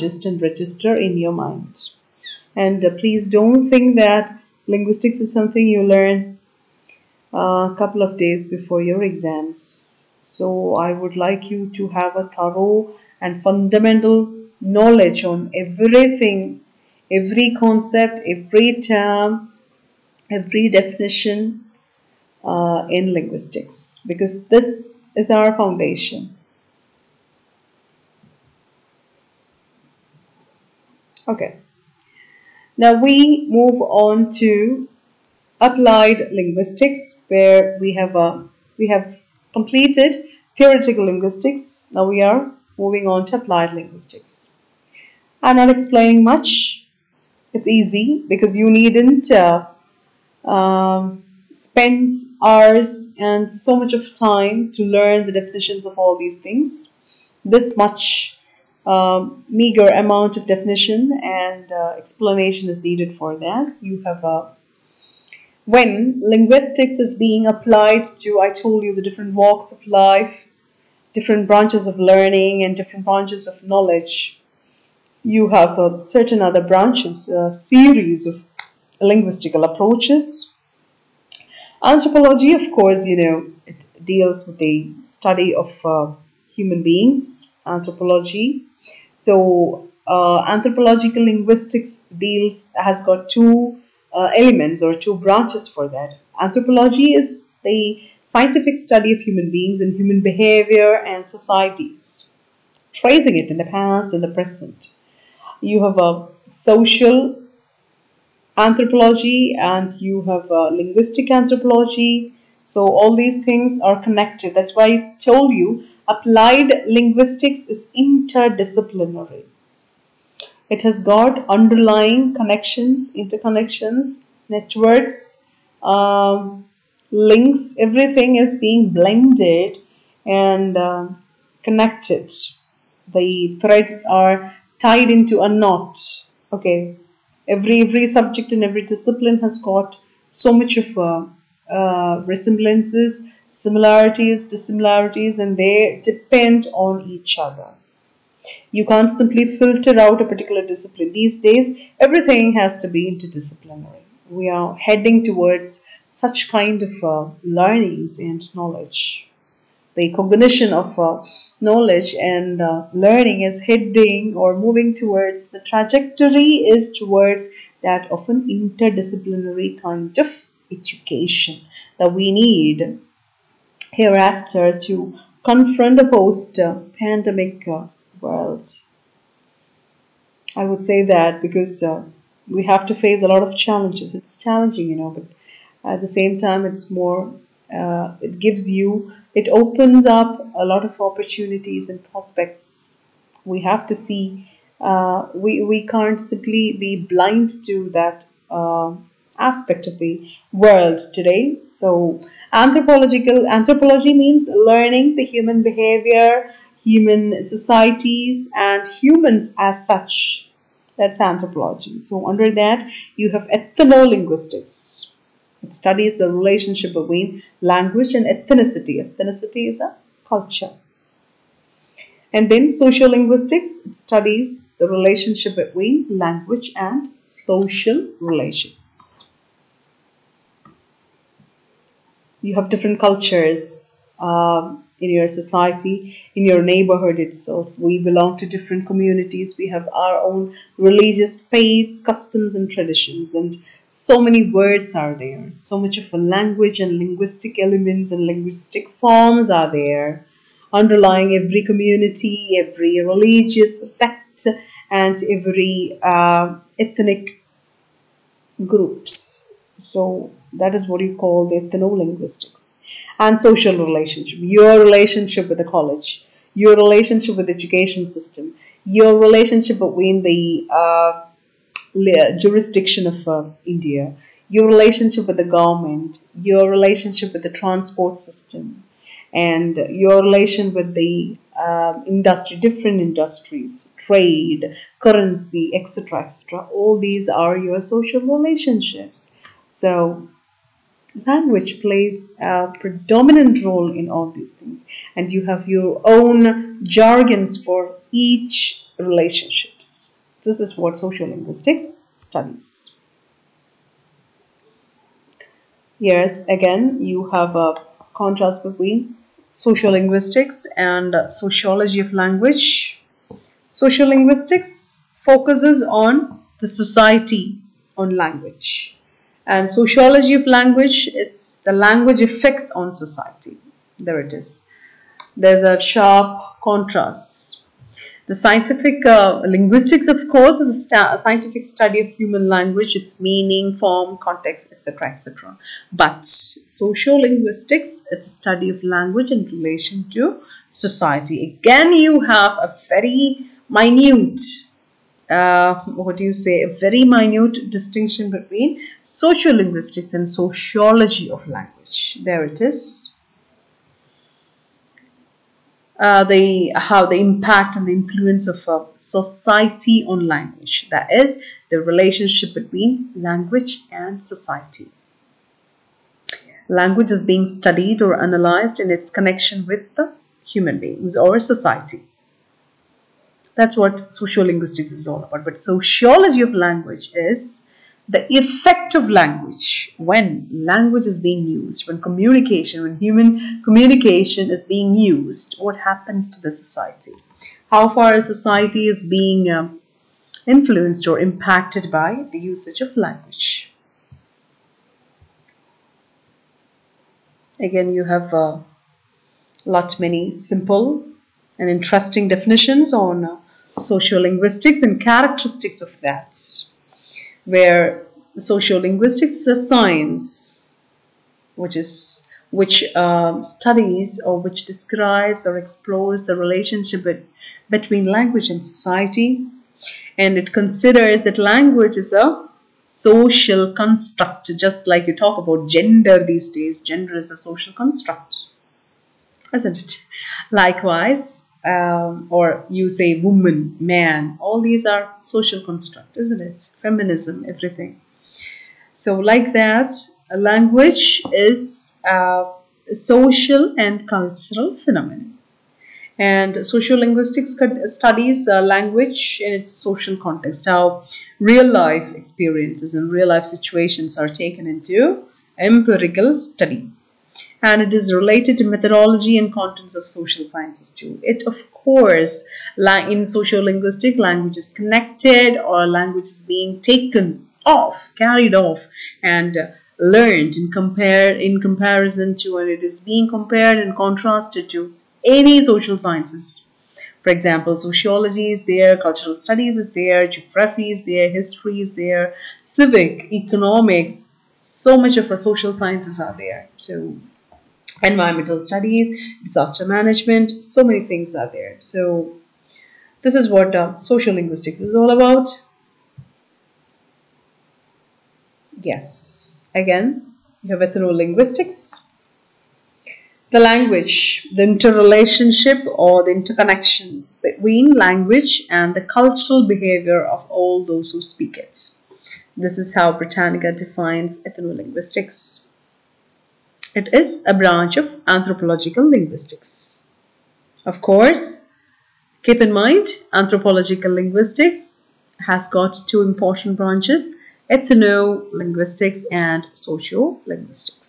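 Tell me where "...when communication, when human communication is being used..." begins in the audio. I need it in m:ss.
6:21.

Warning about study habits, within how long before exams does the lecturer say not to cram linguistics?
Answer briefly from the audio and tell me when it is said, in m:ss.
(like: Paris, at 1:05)
a couple of days, at 0:07.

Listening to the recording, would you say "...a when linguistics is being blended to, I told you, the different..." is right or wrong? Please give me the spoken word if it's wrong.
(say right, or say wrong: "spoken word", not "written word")
wrong: "applied", not "blended".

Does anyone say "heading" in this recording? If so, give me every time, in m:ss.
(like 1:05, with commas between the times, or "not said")
2:34, 2:43.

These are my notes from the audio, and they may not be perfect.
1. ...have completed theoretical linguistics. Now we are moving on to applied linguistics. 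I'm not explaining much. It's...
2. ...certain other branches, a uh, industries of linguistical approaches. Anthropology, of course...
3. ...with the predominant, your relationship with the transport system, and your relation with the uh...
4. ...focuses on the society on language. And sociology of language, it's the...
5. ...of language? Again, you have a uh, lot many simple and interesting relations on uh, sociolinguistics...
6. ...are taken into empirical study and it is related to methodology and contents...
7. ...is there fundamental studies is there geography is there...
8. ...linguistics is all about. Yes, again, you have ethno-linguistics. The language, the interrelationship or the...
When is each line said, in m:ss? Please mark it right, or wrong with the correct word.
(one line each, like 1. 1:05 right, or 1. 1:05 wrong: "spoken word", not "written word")
1. 0:38 right
2. 1:15 wrong: "series", not "industries"
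3. 4:35 wrong: "government", not "predominant"
4. 5:15 right
5. 6:32 wrong: "definitions", not "relations"
6. 7:34 right
7. 7:58 wrong: "cultural", not "fundamental"
8. 8:14 right.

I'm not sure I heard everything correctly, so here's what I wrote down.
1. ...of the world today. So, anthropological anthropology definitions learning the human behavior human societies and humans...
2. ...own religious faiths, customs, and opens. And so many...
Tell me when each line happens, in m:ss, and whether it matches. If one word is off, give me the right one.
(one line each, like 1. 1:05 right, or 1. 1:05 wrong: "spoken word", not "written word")
1. 3:19 wrong: "means", not "definitions"
2. 4:00 wrong: "traditions", not "opens".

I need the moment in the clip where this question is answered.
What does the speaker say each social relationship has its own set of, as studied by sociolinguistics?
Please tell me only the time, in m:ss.
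4:56.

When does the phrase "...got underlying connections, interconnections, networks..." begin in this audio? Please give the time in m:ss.
2:01.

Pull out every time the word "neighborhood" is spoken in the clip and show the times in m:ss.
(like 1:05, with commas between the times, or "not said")
3:56.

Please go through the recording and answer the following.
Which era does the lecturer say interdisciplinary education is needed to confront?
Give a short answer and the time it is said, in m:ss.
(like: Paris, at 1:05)
post-pandemic, at 2:56.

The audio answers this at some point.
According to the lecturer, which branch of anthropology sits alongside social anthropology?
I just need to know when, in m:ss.
1:50.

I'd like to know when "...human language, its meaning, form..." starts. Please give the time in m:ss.
5:32.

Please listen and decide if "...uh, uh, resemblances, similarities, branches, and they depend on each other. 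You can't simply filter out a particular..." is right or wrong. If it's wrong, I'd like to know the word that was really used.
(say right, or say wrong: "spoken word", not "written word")
wrong: "dissimilarities", not "branches".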